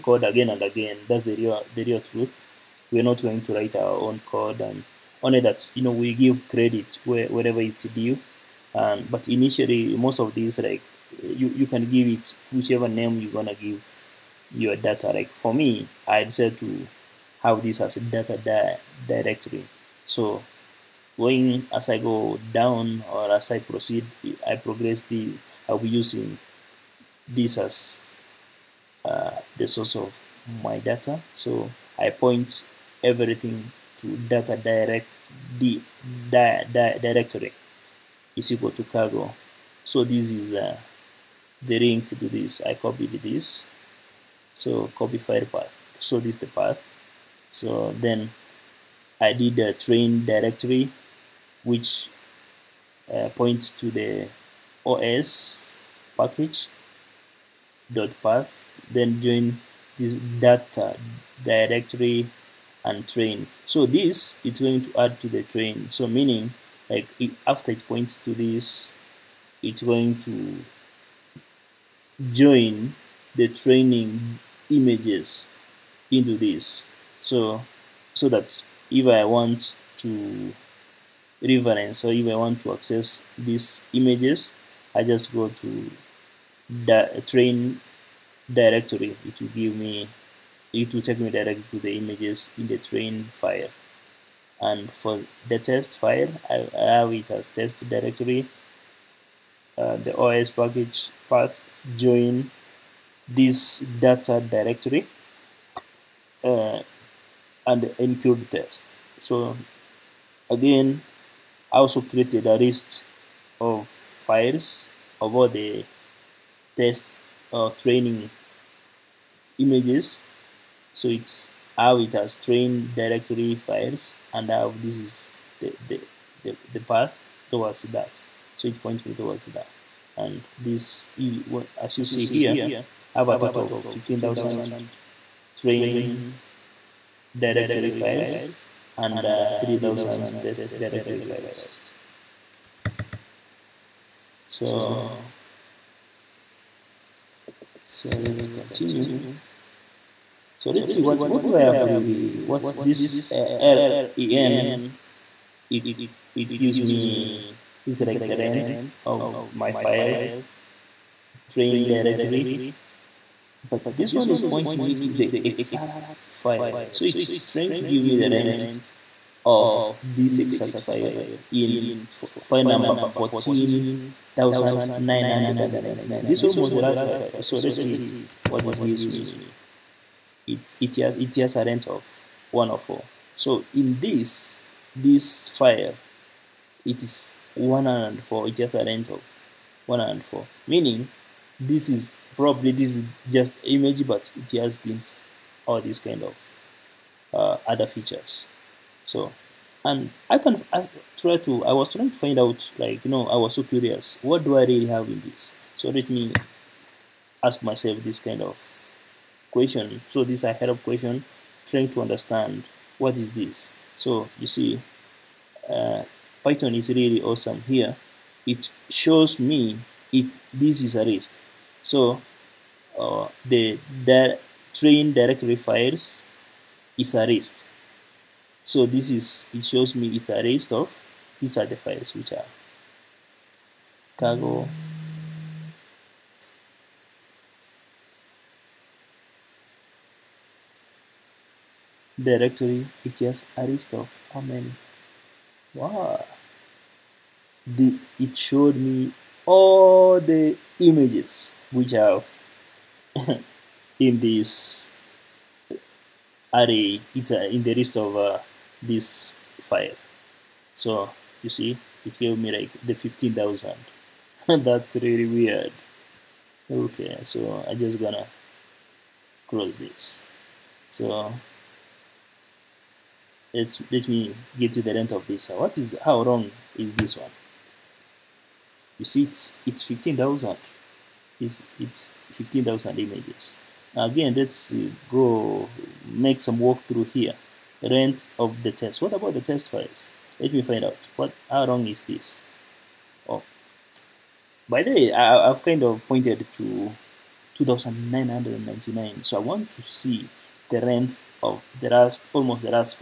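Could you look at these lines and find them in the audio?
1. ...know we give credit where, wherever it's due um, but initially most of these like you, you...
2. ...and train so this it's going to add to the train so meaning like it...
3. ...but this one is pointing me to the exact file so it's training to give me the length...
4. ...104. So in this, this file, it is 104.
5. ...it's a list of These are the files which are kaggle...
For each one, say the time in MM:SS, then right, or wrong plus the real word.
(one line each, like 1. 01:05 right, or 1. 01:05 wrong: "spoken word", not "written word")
1. 00:05 right
2. 01:02 right
3. 02:43 wrong: "trying", not "training"
4. 03:02 right
5. 03:50 right.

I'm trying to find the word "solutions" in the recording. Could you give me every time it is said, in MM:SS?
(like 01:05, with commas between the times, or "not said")
not said.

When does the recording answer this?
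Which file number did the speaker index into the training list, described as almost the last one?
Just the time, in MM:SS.
02:52.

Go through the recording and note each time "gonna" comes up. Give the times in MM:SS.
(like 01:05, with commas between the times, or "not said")
00:13, 04:27.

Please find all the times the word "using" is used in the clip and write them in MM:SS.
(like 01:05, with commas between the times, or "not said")
00:25.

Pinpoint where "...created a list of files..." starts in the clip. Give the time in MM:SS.
01:52.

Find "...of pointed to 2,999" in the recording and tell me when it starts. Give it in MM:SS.
04:55.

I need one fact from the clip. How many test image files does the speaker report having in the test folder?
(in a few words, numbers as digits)
3000.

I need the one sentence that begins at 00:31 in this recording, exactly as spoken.
So I point everything to data direct di, di, di directory is equal to kaggle.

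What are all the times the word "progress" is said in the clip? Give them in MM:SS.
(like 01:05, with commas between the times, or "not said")
00:24.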